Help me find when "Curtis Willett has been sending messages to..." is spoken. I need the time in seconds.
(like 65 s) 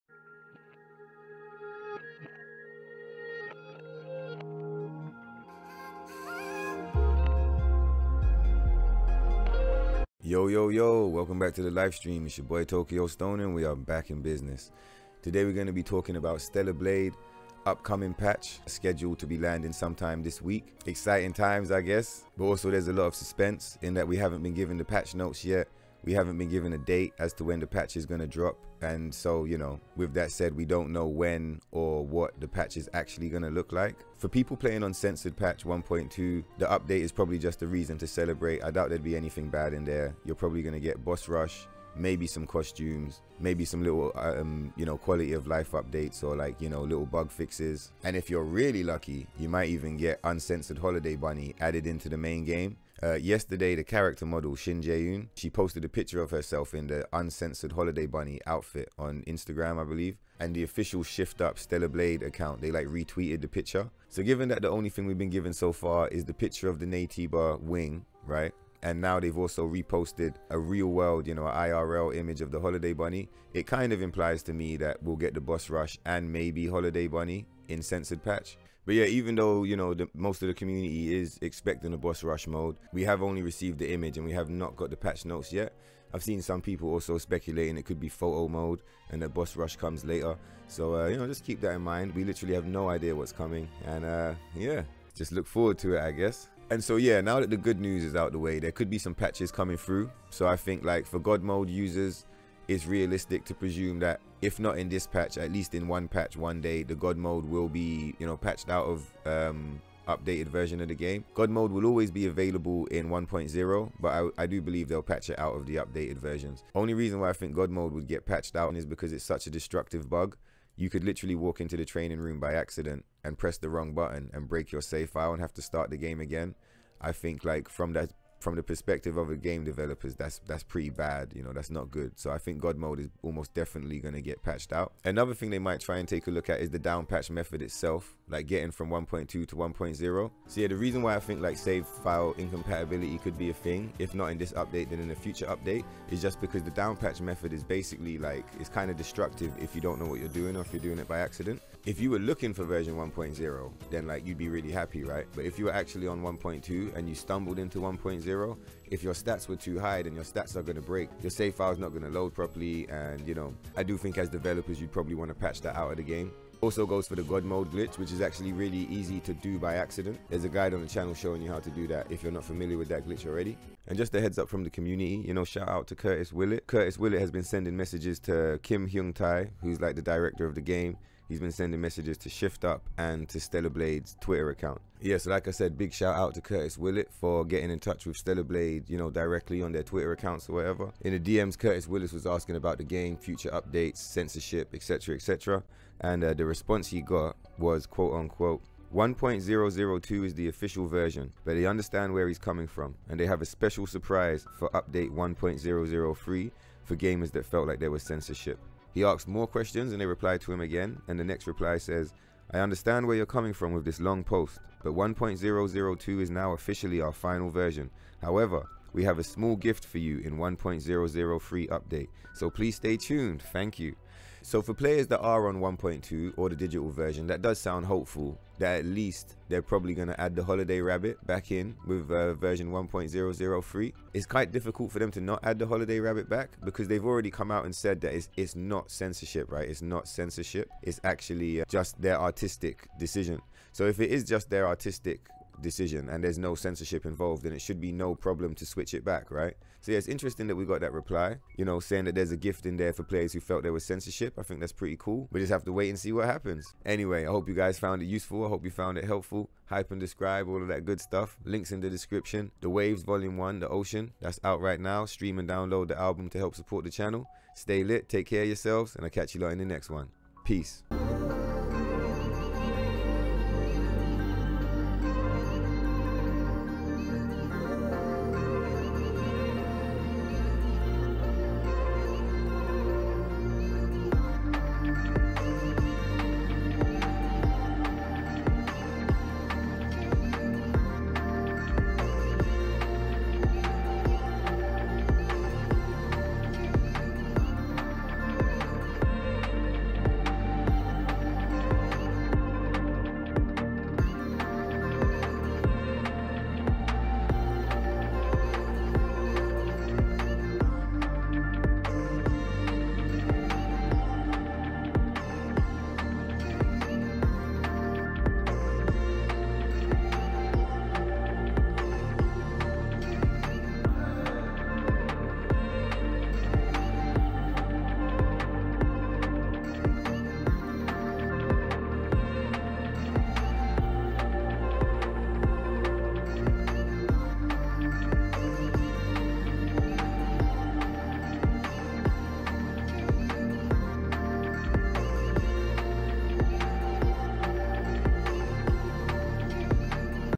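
176 s.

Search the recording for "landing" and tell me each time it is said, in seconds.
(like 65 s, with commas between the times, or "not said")
19 s.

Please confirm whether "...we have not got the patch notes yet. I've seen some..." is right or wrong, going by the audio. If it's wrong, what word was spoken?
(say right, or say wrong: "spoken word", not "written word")
right.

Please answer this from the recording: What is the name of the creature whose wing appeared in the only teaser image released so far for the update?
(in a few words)
Naytiba.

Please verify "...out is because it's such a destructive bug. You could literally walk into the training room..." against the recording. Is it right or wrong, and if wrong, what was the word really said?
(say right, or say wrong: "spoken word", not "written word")
right.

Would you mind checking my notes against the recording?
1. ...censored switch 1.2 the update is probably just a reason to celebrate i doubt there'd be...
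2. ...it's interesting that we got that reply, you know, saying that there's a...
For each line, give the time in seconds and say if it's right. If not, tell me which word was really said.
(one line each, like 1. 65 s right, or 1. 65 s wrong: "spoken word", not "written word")
1. 34 s wrong: "patch", not "switch"
2. 249 s right.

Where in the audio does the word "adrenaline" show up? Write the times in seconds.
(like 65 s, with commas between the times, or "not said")
not said.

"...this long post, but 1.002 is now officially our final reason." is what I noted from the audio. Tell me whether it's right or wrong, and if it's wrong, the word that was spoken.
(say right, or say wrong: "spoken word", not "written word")
wrong: "version", not "reason".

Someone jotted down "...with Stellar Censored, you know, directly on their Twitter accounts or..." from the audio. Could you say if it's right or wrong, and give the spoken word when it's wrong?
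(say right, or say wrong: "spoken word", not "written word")
wrong: "Blade", not "Censored".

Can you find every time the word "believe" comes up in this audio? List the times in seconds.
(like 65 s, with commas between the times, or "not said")
59 s, 114 s.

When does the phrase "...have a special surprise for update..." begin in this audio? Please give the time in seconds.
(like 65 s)
203 s.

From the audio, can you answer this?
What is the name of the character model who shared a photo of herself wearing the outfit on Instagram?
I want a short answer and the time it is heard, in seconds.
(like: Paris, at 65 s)
Shin Jae-eun, at 54 s.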